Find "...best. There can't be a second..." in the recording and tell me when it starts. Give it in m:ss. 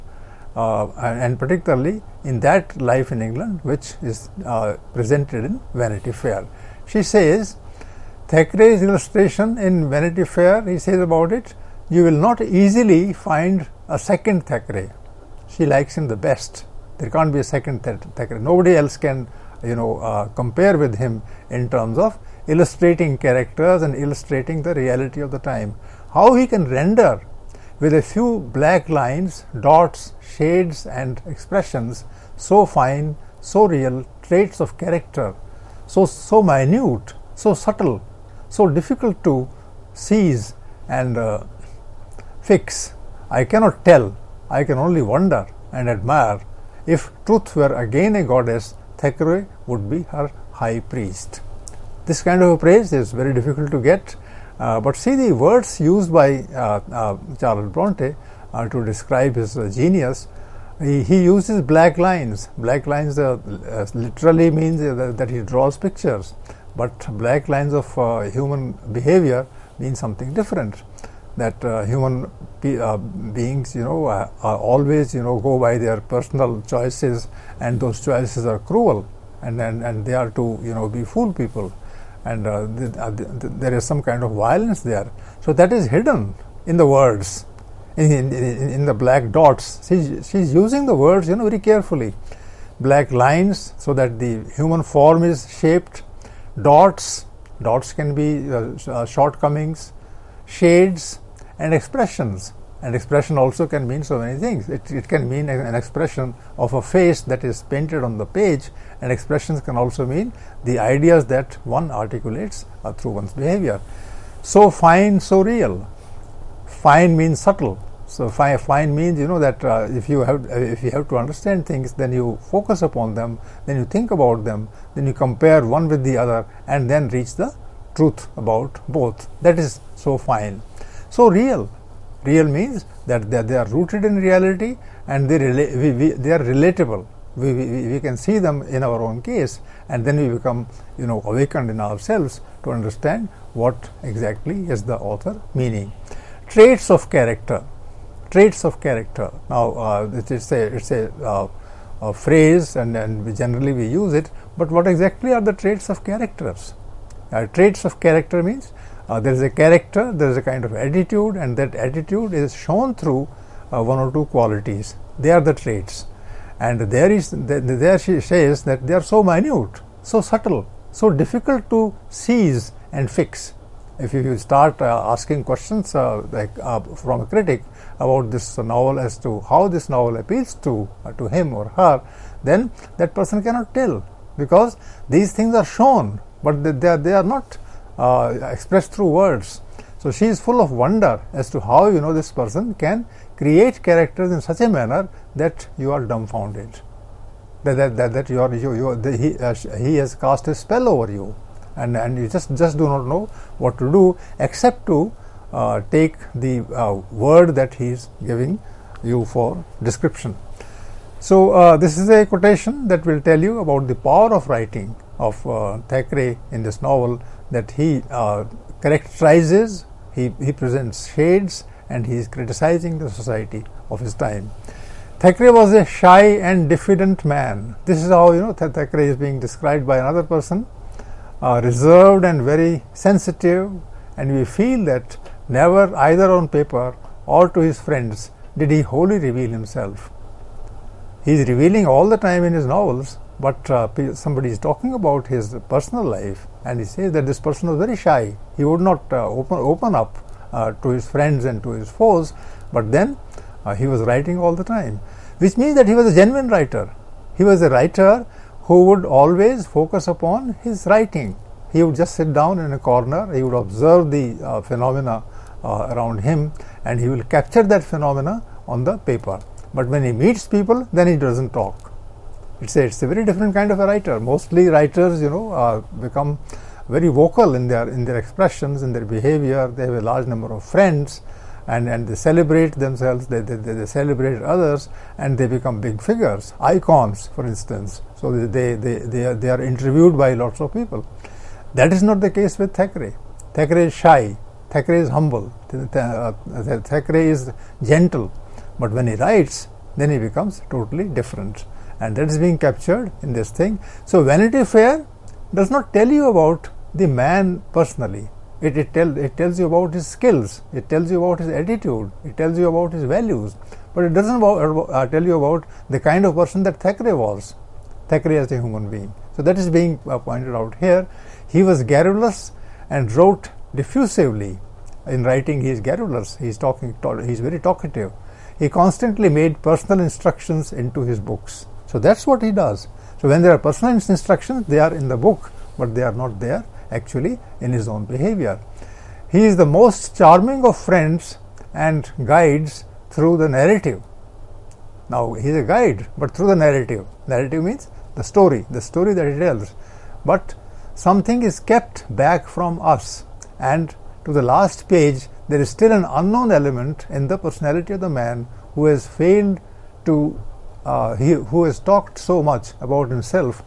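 0:16.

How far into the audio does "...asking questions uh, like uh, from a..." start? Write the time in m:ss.
2:55.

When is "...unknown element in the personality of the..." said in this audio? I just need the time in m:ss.
5:56.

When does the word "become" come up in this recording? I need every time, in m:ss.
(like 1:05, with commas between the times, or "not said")
2:20, 4:36, 4:45, 5:00.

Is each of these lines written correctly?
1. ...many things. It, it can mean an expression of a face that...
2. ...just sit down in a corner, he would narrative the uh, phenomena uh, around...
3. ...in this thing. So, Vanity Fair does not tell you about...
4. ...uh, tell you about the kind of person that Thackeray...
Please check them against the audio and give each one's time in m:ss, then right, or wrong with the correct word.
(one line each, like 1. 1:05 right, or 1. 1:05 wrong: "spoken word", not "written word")
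1. 1:44 right
2. 4:21 wrong: "observe", not "narrative"
3. 5:03 right
4. 5:14 right.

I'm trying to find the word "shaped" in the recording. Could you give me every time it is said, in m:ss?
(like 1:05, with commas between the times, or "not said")
1:35.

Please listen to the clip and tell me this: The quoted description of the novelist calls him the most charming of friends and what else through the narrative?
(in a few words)
Guides.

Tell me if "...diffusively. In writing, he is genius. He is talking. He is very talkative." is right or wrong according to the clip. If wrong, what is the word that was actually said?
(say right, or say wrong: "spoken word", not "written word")
wrong: "garrulous", not "genius".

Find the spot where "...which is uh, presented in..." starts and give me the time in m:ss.
0:03.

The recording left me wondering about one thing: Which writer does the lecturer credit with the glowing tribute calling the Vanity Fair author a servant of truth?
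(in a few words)
Charles Bronte.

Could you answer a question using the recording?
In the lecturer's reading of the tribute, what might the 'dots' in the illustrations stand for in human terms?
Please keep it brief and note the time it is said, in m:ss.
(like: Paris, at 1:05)
Shortcomings, at 1:39.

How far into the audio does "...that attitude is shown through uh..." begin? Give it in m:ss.
2:41.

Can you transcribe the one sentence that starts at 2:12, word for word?
Real means that they, they are rooted in reality and they, rela- we, we, they are relatable.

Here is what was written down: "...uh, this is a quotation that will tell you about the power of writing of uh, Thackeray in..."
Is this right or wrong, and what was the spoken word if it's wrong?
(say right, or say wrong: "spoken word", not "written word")
right.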